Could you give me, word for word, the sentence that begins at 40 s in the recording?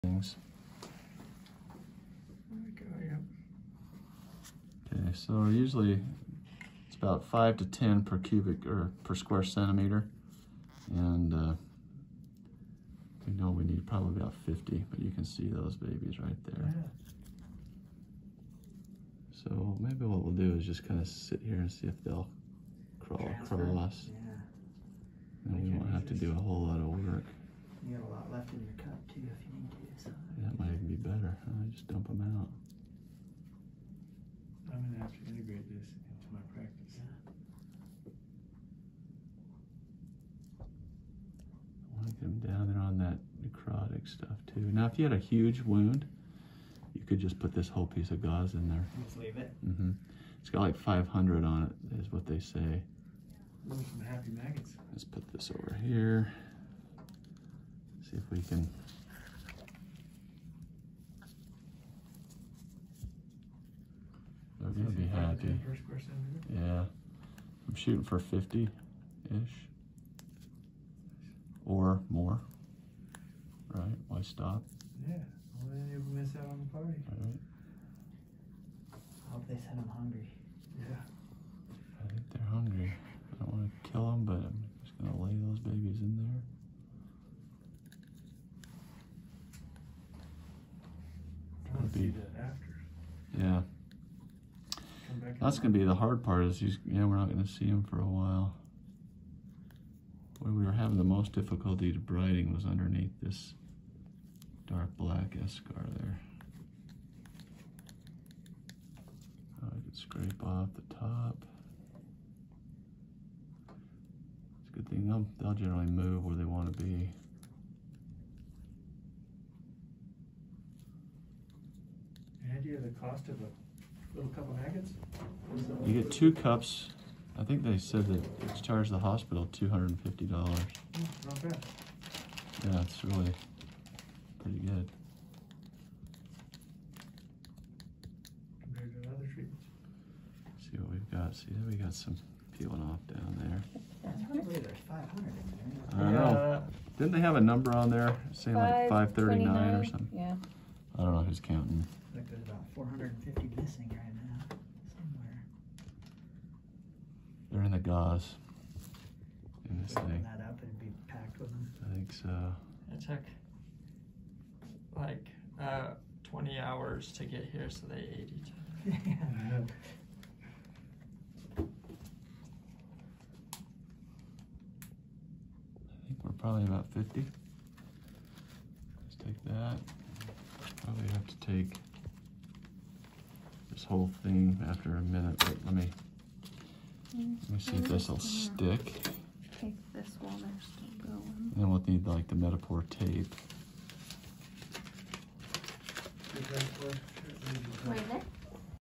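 I want them down there on that necrotic stuff too.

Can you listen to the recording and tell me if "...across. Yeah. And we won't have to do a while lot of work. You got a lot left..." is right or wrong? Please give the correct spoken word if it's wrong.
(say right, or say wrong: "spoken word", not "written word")
wrong: "whole", not "while".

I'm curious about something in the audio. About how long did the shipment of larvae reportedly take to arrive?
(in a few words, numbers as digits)
20 hours.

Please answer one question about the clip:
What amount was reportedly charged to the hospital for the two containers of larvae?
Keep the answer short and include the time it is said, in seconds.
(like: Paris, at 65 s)
$250, at 129 s.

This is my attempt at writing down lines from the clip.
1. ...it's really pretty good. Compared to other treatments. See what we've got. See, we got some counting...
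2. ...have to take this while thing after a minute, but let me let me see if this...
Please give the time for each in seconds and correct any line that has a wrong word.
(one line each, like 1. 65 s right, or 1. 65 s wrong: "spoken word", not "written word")
1. 132 s wrong: "peeling", not "counting"
2. 181 s wrong: "whole", not "while".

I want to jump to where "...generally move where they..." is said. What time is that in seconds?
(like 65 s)
115 s.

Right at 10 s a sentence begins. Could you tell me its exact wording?
And uh, we know we need probably about 50, but you can see those babies right there.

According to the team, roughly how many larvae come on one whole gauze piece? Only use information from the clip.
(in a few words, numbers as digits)
500.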